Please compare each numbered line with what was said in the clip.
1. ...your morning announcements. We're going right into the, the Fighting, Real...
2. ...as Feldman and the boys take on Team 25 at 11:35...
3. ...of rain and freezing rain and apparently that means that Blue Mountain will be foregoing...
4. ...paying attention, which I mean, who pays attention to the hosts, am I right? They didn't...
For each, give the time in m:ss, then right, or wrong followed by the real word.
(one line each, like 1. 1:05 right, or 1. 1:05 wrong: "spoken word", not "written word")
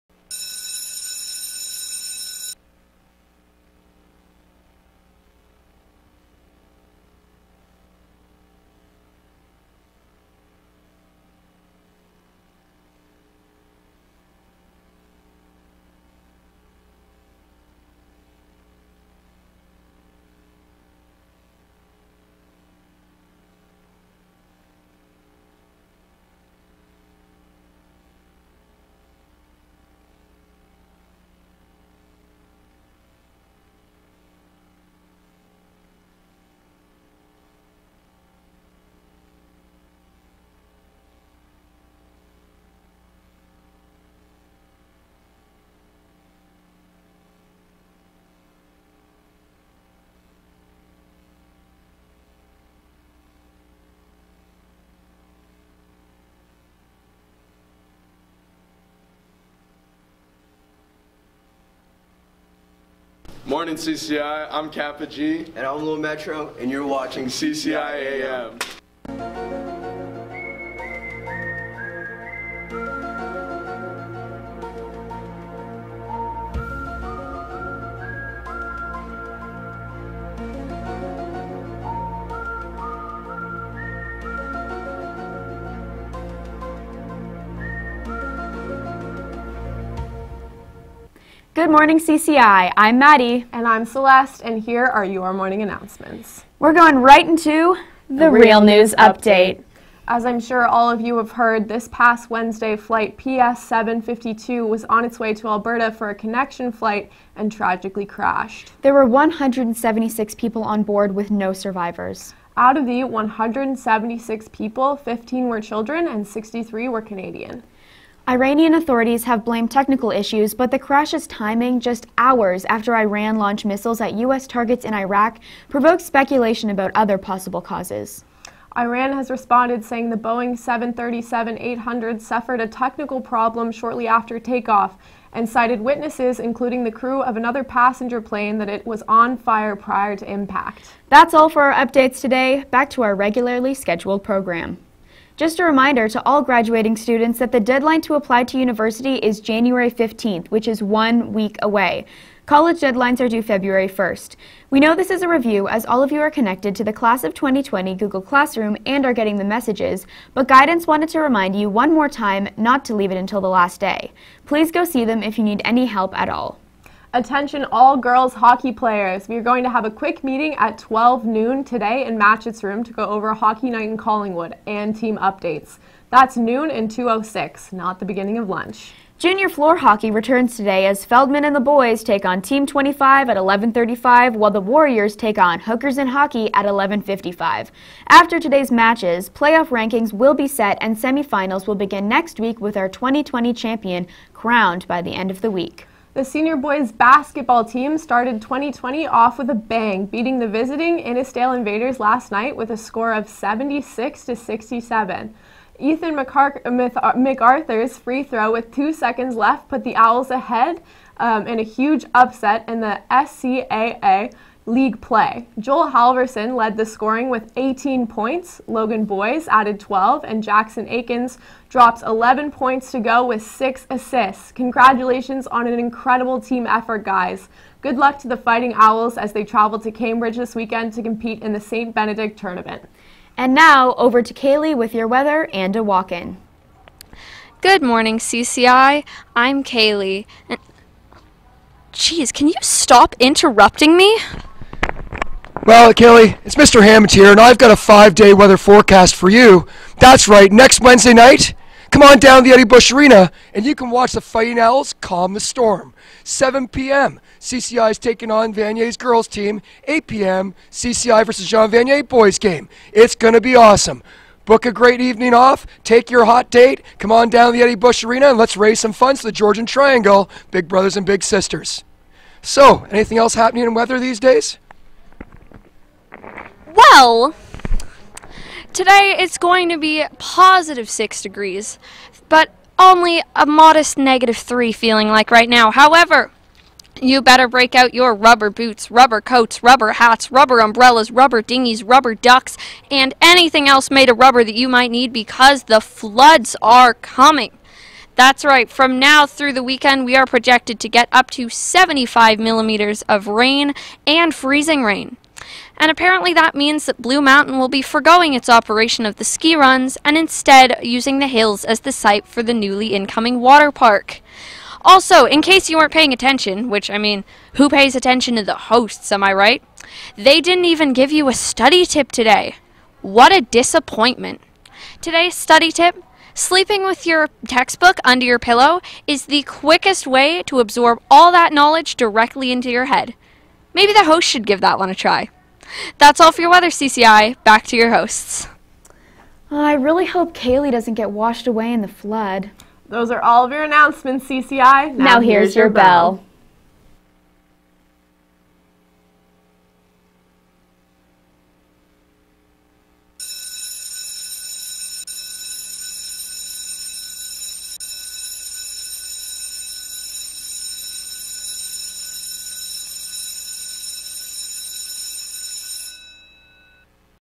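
1. 1:35 wrong: "Real", not "Fighting"
2. 3:00 right
3. 5:03 right
4. 5:15 right.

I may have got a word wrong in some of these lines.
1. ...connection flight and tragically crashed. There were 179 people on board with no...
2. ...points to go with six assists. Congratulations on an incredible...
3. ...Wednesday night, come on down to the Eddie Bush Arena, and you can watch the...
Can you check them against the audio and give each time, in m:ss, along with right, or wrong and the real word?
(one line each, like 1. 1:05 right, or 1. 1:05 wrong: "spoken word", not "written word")
1. 1:46 wrong: "176", not "179"
2. 3:42 right
3. 4:10 right.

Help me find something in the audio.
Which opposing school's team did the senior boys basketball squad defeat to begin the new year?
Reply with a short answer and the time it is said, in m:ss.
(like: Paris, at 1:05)
Innisdale Invaders, at 3:20.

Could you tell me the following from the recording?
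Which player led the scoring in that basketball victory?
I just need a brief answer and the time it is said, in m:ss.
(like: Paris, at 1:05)
Joel Halverson, at 3:35.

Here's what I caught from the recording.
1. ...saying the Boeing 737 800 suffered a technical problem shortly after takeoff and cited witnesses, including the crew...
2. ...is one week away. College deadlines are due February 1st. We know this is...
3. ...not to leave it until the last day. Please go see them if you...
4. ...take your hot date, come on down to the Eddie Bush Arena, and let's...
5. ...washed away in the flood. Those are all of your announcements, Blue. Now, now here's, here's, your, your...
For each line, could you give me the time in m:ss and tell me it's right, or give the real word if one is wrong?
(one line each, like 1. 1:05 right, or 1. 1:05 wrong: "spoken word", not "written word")
1. 2:09 right
2. 2:30 right
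3. 2:42 right
4. 4:25 right
5. 5:41 wrong: "CCI", not "Blue".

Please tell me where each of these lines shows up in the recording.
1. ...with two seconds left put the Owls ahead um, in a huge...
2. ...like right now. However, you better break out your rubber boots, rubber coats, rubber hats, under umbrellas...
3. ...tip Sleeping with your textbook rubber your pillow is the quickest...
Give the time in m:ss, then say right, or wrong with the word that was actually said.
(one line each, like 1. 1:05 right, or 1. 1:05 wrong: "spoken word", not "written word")
1. 3:28 right
2. 4:45 wrong: "rubber", not "under"
3. 5:25 wrong: "under", not "rubber".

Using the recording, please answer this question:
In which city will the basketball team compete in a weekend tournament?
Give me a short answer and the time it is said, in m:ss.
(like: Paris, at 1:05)
Cambridge, at 3:49.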